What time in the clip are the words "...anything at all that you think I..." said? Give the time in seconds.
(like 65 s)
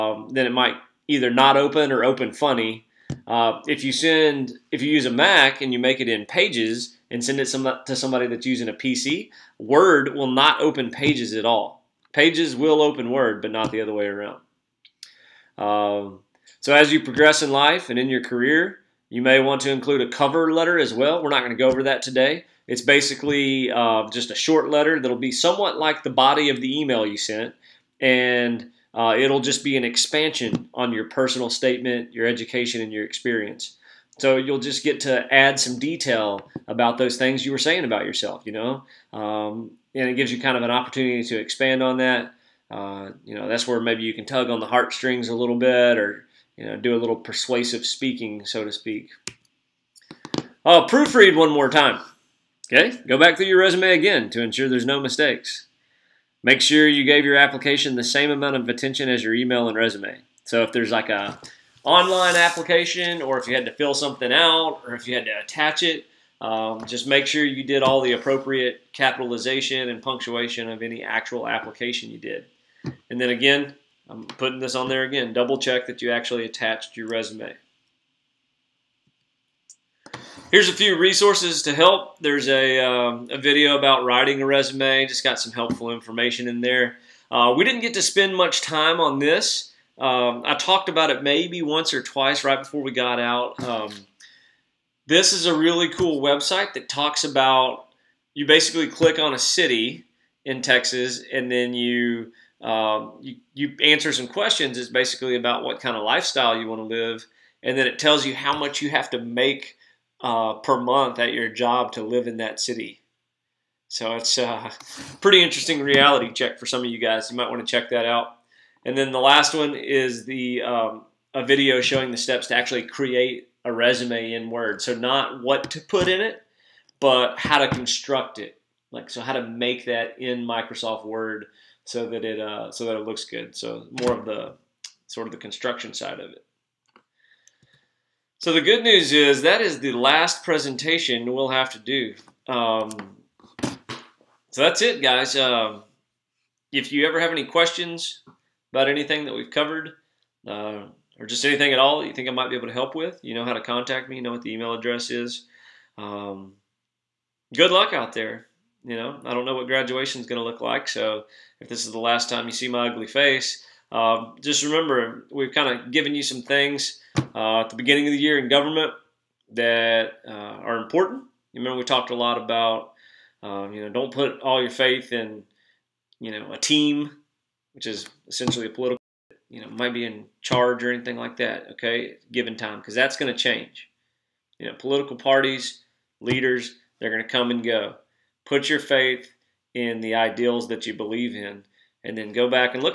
151 s.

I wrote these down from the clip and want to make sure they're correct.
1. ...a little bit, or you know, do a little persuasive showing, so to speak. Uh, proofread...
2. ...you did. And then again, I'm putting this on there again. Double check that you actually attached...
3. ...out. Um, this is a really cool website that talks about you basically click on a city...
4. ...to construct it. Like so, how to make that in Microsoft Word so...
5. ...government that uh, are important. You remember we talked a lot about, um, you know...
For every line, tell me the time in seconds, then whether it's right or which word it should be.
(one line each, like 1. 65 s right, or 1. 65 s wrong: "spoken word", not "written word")
1. 45 s wrong: "speaking", not "showing"
2. 72 s right
3. 93 s right
4. 127 s right
5. 168 s right.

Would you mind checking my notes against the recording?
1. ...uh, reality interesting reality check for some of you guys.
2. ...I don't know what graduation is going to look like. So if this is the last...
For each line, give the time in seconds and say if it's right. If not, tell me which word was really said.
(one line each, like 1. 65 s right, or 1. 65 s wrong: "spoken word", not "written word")
1. 114 s wrong: "pretty", not "reality"
2. 159 s right.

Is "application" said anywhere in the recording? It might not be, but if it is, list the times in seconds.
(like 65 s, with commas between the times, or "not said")
57 s, 62 s, 71 s.